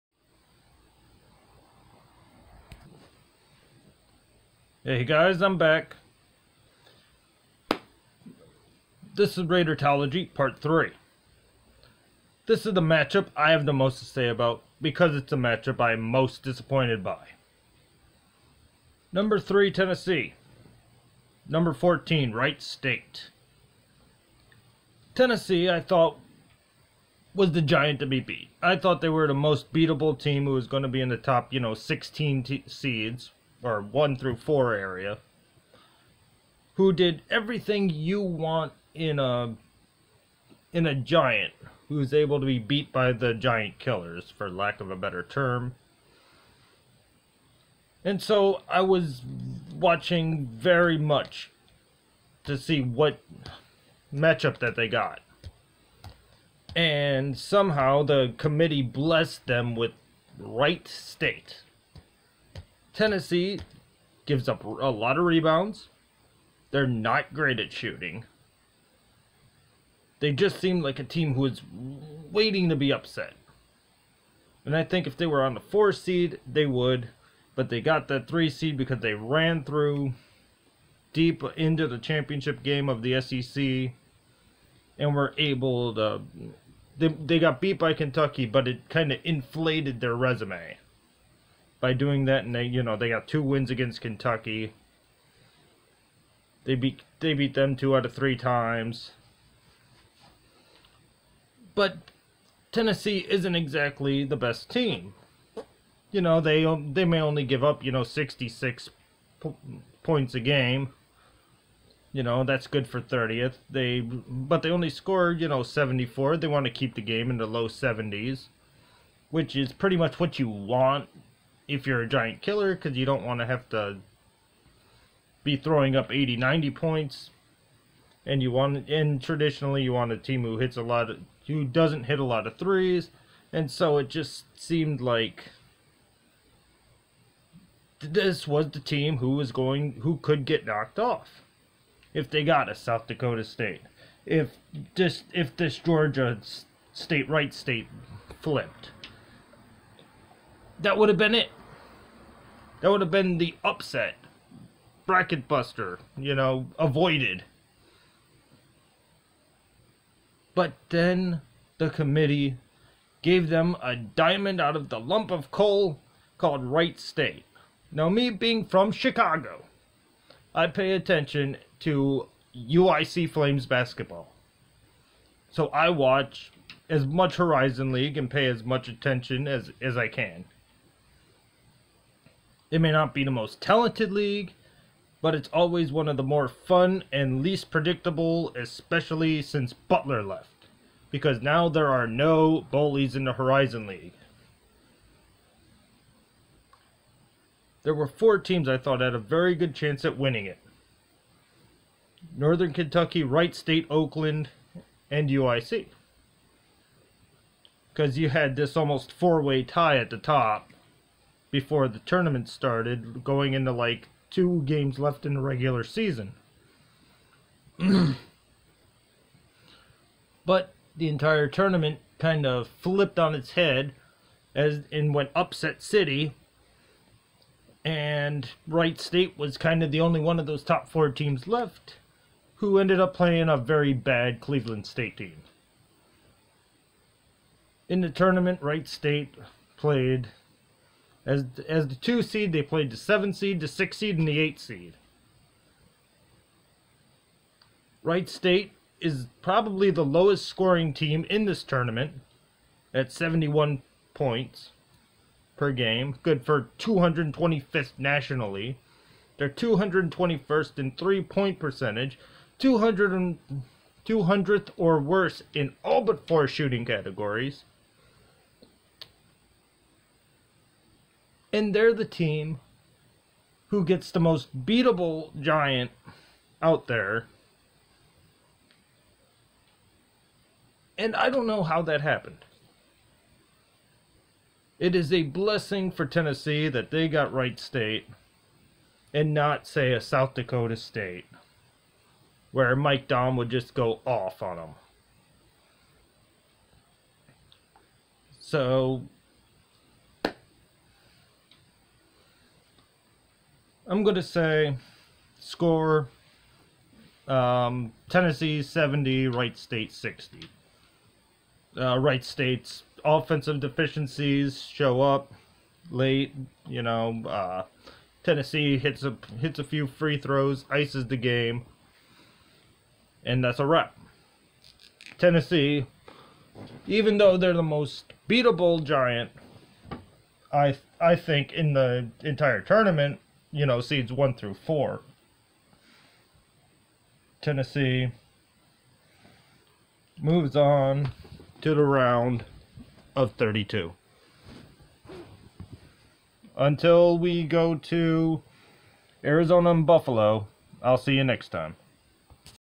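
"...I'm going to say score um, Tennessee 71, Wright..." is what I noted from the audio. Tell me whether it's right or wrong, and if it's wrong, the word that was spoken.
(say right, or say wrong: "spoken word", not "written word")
wrong: "70", not "71".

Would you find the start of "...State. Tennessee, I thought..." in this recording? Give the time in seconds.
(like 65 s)
22 s.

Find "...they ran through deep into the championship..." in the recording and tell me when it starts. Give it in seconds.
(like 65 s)
79 s.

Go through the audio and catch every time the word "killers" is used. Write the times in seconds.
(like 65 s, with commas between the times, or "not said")
43 s, 122 s.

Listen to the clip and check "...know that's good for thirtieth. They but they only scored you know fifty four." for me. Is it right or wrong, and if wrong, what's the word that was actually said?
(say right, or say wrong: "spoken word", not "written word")
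wrong: "seventy", not "fifty".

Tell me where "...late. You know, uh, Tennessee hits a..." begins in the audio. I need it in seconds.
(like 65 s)
315 s.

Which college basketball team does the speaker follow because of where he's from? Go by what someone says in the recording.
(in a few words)
UIC Flames.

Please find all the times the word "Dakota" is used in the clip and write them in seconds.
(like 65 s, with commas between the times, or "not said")
143 s, 290 s.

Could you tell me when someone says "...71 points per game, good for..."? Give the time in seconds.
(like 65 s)
253 s.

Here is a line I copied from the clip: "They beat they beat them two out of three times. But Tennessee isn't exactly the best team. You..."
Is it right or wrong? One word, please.
right.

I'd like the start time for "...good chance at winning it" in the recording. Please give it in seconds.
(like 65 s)
199 s.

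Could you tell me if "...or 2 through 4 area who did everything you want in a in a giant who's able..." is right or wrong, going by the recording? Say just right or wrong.
wrong.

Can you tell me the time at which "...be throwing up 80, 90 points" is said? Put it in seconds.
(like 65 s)
125 s.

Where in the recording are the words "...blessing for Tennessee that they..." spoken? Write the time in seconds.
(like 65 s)
285 s.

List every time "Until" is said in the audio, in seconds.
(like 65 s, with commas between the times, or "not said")
346 s.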